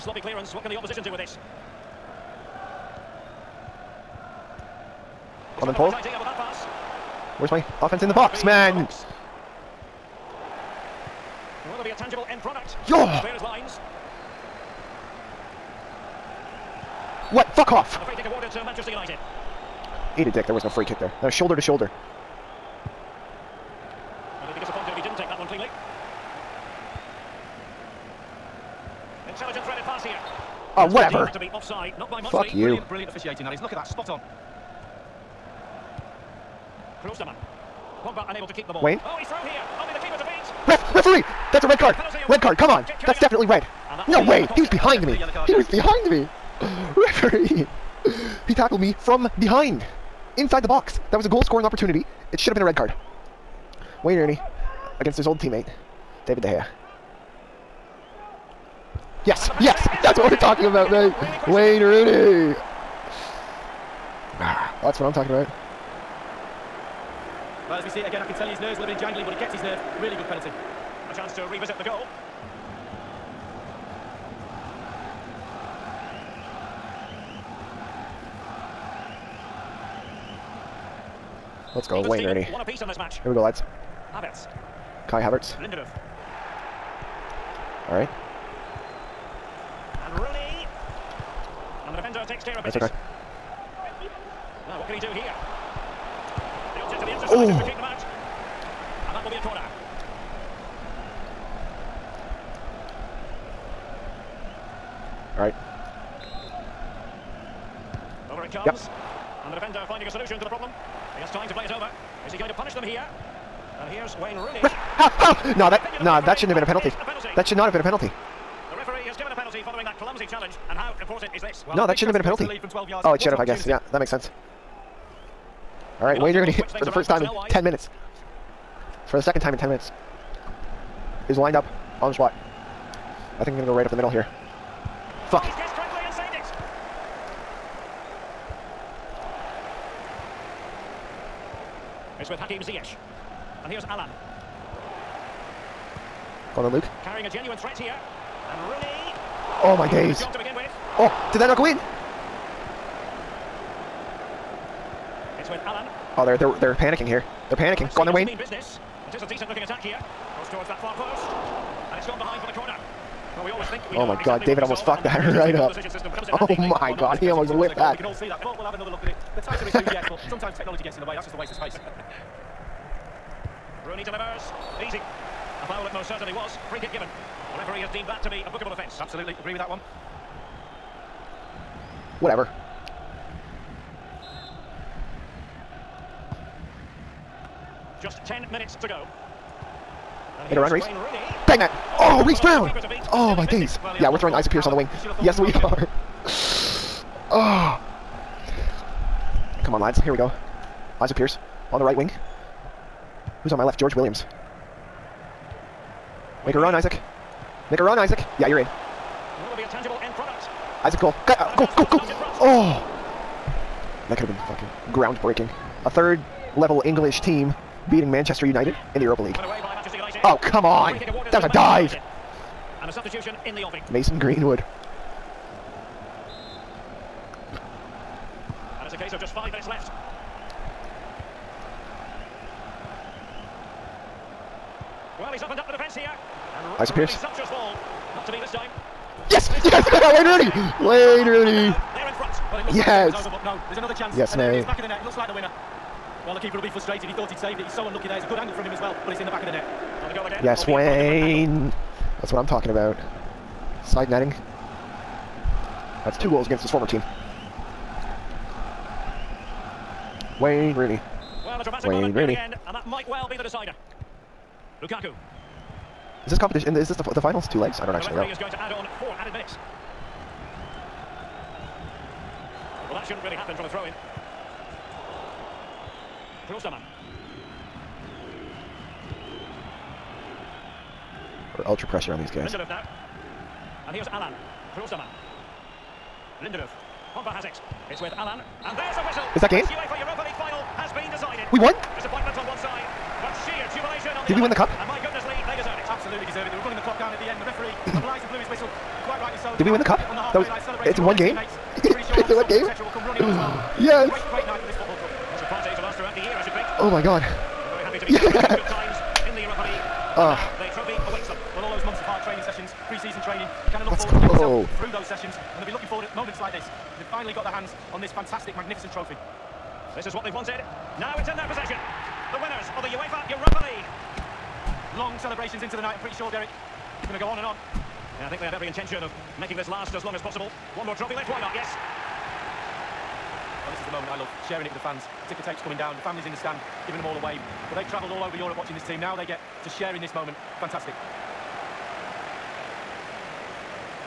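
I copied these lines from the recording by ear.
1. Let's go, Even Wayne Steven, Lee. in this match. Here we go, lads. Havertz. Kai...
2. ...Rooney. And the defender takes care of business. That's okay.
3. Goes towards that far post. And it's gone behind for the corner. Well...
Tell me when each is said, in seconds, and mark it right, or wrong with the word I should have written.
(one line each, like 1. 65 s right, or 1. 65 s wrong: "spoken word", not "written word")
1. 81 s wrong: "Rooney", not "Lee"
2. 90 s right
3. 160 s right.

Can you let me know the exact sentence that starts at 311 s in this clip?
Well, all those months of hard training sessions, pre-season training, you kind of look Let's forward go.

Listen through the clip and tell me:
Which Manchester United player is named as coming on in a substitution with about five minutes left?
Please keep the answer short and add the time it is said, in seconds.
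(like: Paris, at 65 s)
Mason Greenwood, at 223 s.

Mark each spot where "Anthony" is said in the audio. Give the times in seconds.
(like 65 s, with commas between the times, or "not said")
not said.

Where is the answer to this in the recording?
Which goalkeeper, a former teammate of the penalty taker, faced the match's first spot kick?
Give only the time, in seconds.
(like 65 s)
56 s.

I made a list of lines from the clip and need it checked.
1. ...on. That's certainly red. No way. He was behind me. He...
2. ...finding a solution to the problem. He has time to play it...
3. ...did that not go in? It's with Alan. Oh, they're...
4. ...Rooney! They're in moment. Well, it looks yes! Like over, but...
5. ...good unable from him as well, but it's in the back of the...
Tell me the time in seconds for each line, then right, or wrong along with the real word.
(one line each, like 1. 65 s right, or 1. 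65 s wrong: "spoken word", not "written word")
1. 42 s wrong: "definitely", not "certainly"
2. 109 s right
3. 151 s right
4. 241 s wrong: "front", not "moment"
5. 248 s wrong: "angle", not "unable".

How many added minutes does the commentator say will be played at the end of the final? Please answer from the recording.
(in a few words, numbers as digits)
4.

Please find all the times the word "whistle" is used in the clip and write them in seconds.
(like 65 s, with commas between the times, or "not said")
289 s, 298 s.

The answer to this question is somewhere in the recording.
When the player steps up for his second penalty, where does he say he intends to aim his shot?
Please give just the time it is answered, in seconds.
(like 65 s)
133 s.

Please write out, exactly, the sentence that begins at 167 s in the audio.
We can all see that, but we'll have another look at it.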